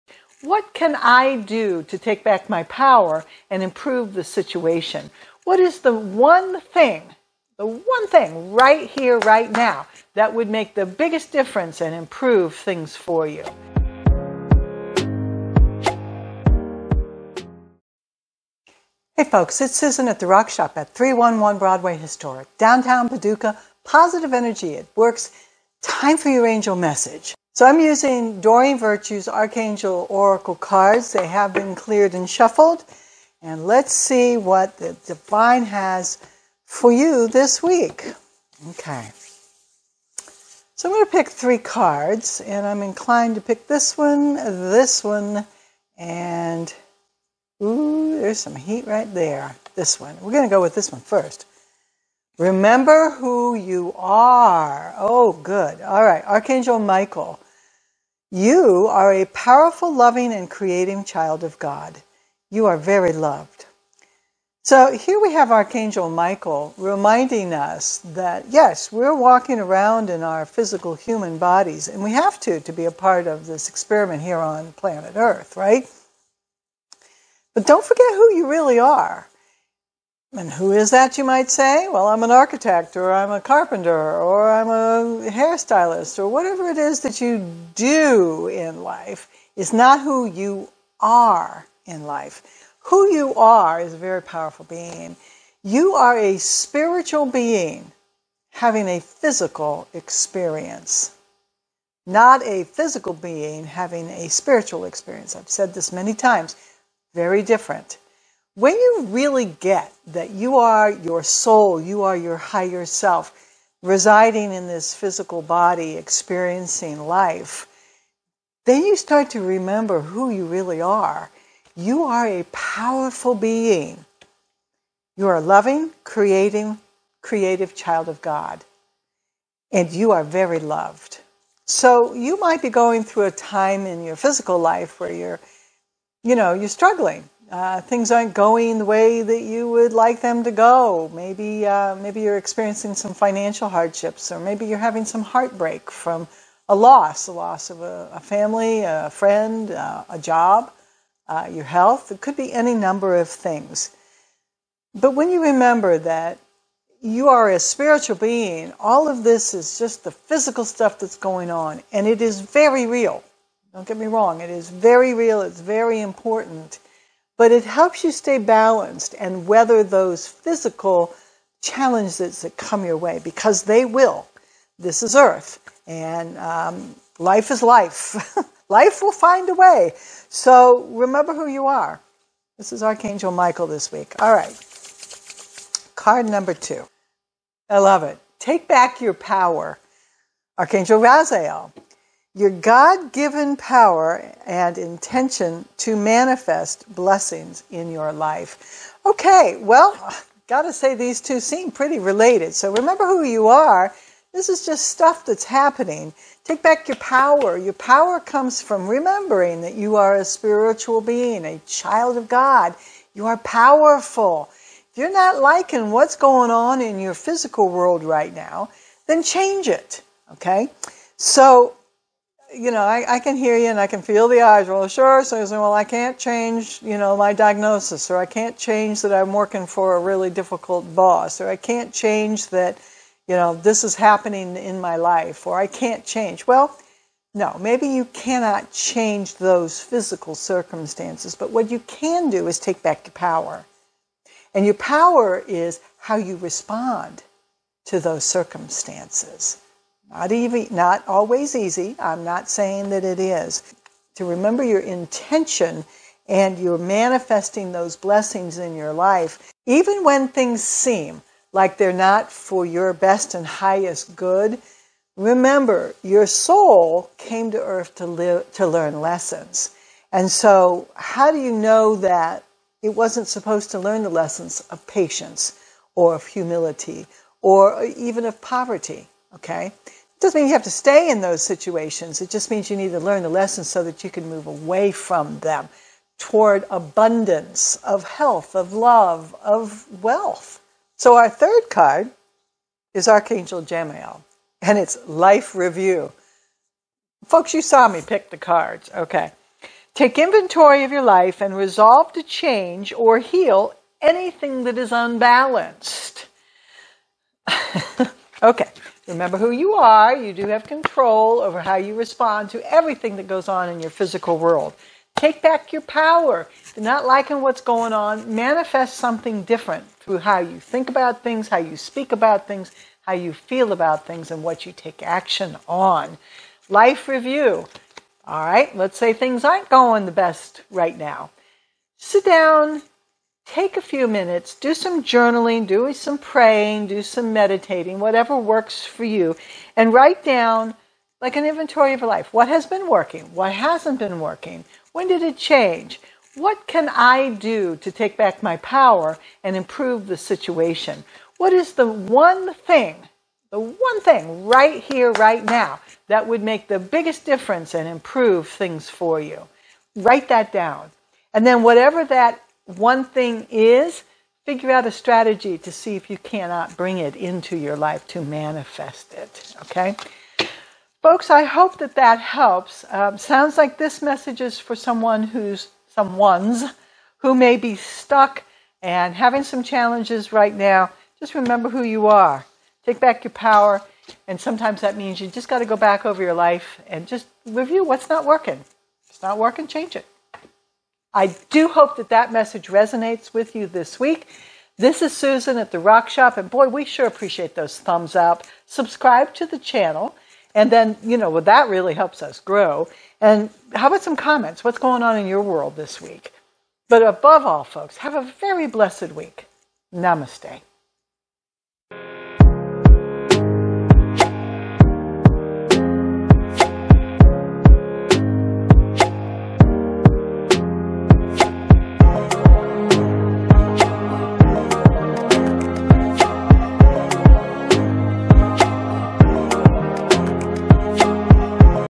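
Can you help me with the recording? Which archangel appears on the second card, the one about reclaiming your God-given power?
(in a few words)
Archangel Raziel.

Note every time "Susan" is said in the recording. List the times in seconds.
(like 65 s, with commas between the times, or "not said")
19 s, 395 s.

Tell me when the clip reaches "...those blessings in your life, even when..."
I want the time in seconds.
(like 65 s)
257 s.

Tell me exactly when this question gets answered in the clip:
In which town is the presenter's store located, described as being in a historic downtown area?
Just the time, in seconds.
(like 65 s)
23 s.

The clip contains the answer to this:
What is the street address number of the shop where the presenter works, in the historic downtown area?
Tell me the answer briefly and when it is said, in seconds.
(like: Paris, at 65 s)
311, at 20 s.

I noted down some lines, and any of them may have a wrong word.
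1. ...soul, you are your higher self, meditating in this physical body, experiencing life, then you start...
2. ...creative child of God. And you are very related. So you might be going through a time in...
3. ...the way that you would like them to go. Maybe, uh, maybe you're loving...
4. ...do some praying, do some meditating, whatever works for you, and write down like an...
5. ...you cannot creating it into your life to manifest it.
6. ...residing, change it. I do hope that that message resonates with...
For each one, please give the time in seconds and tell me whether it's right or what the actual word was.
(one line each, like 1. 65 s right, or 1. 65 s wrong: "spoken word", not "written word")
1. 111 s wrong: "residing", not "meditating"
2. 127 s wrong: "loved", not "related"
3. 138 s wrong: "experiencing", not "loving"
4. 335 s right
5. 366 s wrong: "bring", not "creating"
6. 389 s wrong: "working", not "residing".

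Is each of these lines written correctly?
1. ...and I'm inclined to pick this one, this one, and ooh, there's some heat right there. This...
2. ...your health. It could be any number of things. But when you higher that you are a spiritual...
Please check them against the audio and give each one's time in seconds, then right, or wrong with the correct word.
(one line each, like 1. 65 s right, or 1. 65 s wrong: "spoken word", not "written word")
1. 42 s right
2. 151 s wrong: "remember", not "higher".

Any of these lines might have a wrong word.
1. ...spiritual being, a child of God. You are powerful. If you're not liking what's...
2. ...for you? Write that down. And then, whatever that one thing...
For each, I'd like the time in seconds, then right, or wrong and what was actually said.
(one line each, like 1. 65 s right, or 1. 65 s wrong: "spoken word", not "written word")
1. 210 s right
2. 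358 s right.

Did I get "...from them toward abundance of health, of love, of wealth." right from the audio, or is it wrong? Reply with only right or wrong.
right.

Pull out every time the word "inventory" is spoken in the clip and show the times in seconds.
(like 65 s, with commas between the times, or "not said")
300 s, 341 s.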